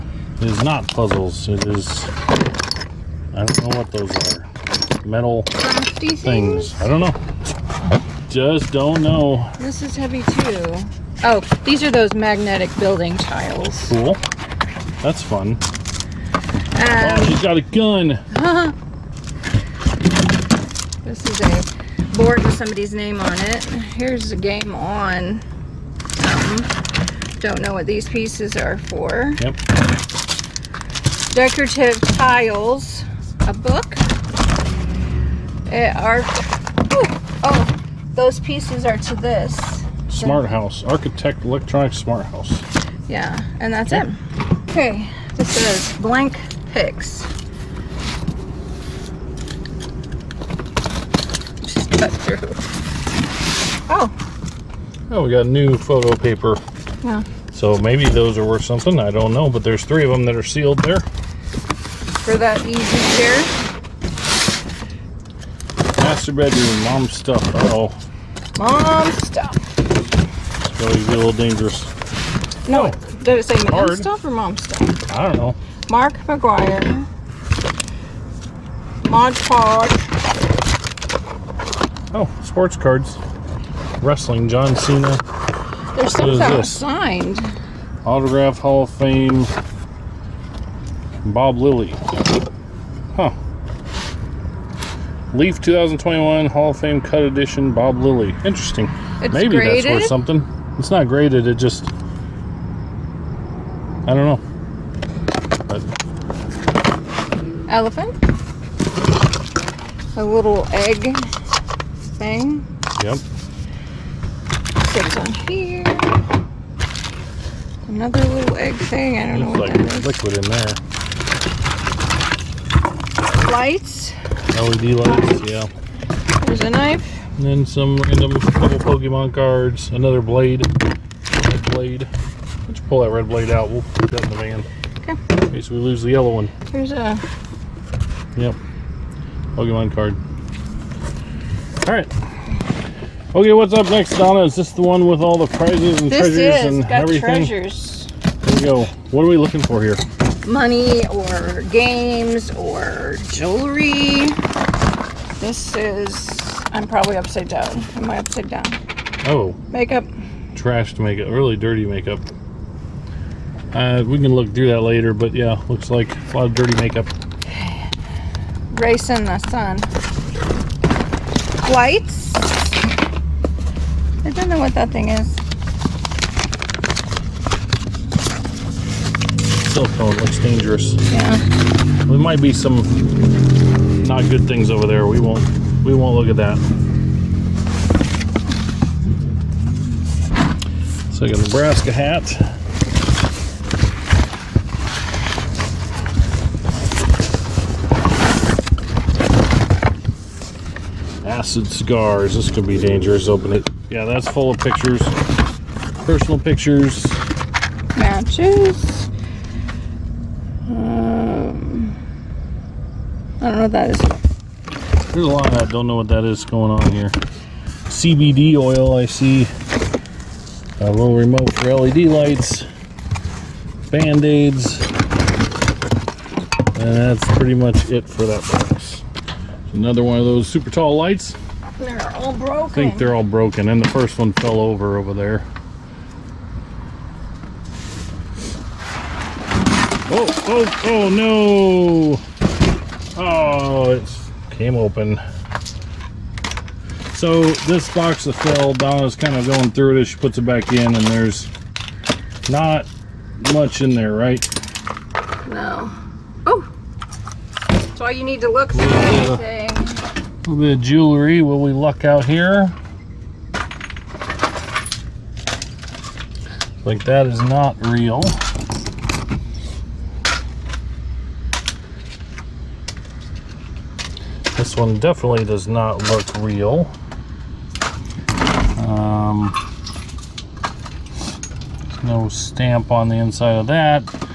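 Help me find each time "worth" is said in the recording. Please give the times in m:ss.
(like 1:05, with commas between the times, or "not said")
0:58, 1:40.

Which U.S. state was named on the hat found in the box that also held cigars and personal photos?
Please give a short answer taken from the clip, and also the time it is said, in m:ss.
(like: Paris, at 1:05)
Nebraska, at 3:11.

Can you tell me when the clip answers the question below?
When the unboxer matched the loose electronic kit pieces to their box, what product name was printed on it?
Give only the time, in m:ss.
0:40.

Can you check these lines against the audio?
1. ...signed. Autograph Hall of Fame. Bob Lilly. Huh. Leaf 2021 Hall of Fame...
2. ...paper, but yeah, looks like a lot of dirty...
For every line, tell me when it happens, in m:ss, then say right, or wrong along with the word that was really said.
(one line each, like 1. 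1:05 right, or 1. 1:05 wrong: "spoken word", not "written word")
1. 1:26 right
2. 2:44 wrong: "later", not "paper".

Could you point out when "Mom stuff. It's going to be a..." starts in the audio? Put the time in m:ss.
1:08.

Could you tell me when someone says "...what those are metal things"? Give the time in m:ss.
0:03.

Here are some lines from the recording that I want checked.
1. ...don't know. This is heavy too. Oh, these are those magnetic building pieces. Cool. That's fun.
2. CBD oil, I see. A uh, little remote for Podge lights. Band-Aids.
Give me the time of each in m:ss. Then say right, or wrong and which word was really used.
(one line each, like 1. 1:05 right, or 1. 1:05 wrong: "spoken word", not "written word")
1. 0:08 wrong: "tiles", not "pieces"
2. 3:37 wrong: "LED", not "Podge".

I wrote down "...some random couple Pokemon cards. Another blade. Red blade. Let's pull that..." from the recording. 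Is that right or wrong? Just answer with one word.
right.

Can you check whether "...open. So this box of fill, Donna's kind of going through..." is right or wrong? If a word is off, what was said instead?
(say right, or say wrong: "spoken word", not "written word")
right.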